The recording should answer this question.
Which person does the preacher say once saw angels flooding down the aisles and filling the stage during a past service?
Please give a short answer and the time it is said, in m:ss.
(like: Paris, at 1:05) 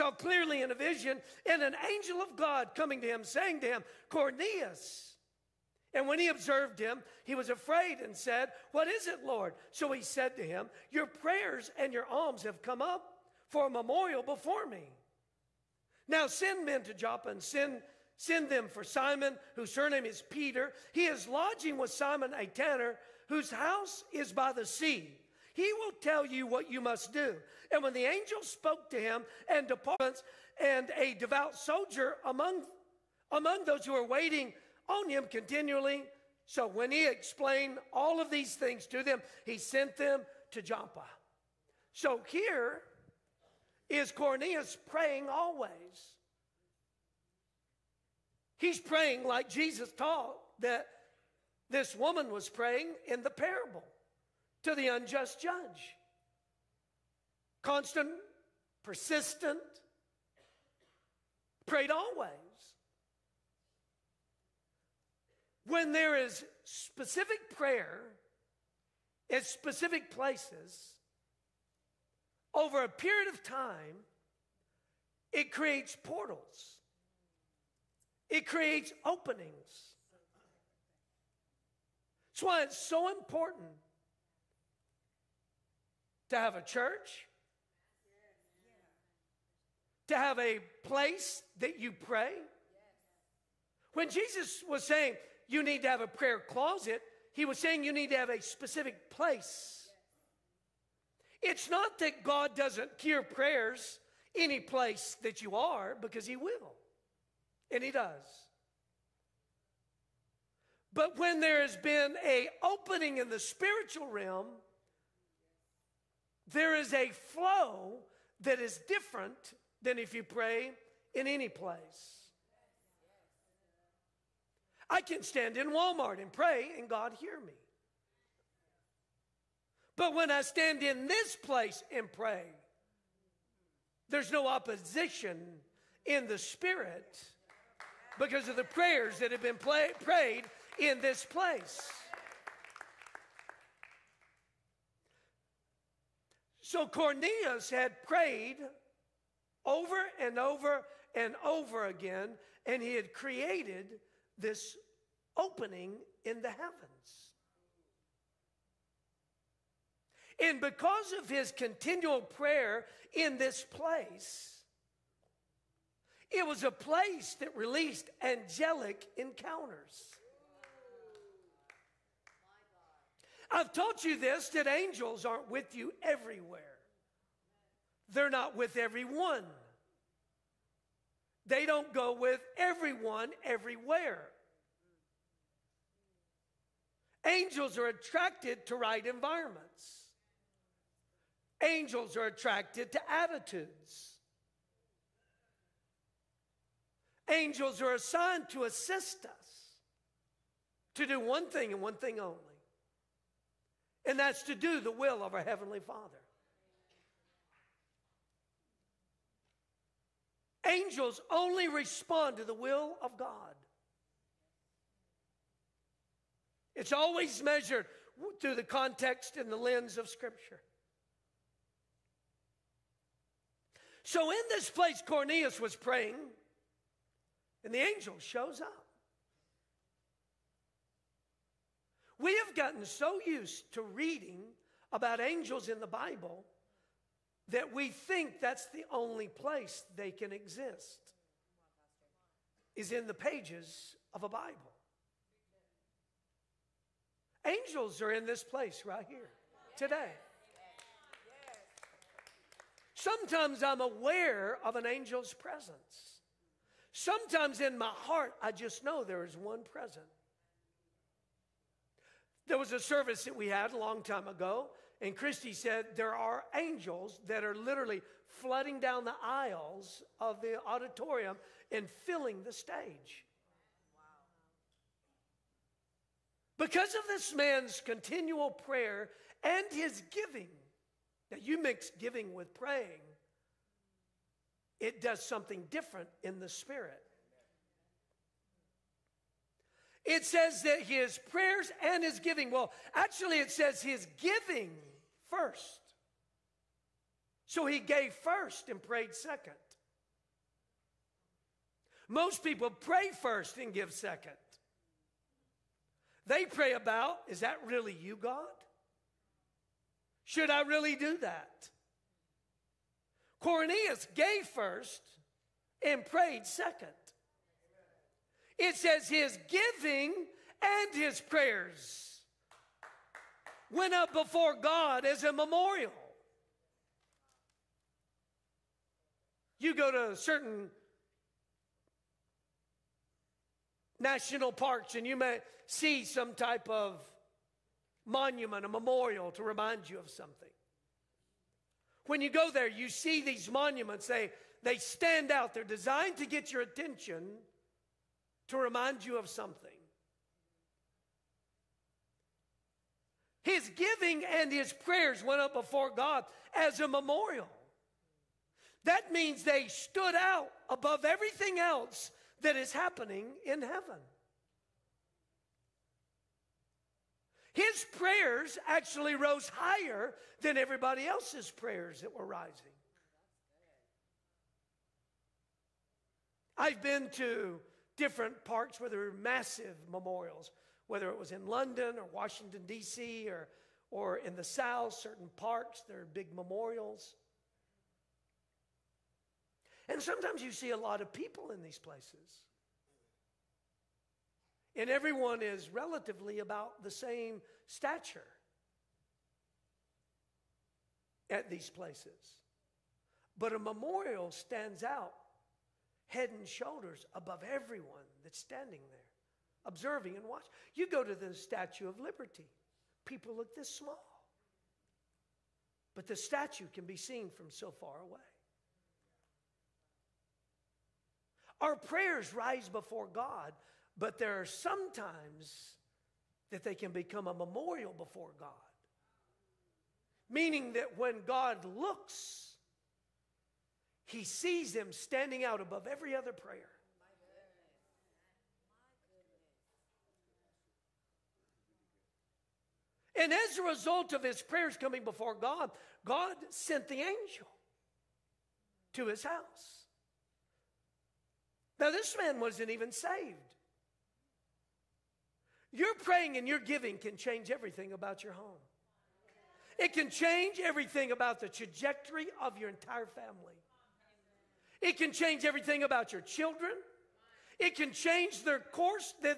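Christy, at 4:25.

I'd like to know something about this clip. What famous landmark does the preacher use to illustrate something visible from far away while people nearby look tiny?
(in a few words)
Statue of Liberty.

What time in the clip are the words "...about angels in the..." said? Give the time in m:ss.
3:54.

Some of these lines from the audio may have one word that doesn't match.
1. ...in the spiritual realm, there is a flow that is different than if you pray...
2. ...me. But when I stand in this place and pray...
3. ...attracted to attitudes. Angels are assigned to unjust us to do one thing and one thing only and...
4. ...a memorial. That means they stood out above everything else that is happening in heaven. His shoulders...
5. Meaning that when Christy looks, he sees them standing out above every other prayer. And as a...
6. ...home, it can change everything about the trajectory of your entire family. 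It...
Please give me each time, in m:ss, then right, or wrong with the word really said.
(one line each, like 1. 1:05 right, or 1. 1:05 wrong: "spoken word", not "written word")
1. 1:53 right
2. 2:07 right
3. 3:12 wrong: "assist", not "unjust"
4. 5:56 wrong: "prayers", not "shoulders"
5. 7:10 wrong: "God", not "Christy"
6. 7:38 right.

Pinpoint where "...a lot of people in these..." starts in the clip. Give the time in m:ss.
6:30.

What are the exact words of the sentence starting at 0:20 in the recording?
He is lodging with Simon a tanner, whose house is by the sea.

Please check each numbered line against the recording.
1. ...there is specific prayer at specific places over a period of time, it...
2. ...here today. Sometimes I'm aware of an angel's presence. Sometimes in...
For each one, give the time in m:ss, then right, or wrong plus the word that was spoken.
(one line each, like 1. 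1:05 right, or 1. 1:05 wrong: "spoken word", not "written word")
1. 1:05 right
2. 4:09 right.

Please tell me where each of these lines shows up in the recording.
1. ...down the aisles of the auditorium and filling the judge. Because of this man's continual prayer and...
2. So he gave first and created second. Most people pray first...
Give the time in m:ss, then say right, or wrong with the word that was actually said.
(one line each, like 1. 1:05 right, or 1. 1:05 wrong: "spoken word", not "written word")
1. 4:28 wrong: "stage", not "judge"
2. 4:57 wrong: "prayed", not "created".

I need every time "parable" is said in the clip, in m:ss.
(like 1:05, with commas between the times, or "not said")
0:53.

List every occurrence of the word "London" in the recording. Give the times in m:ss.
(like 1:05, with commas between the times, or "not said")
6:21.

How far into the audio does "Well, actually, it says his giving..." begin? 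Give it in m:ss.
4:52.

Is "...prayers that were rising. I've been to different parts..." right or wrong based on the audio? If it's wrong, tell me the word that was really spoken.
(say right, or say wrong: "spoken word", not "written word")
right.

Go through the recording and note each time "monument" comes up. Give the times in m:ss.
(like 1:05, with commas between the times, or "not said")
5:38, 5:43.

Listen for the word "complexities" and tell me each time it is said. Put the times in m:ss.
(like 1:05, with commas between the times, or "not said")
not said.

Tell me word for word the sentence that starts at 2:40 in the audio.
And because of his continual prayer in this place, it was a place that released angelic encounters.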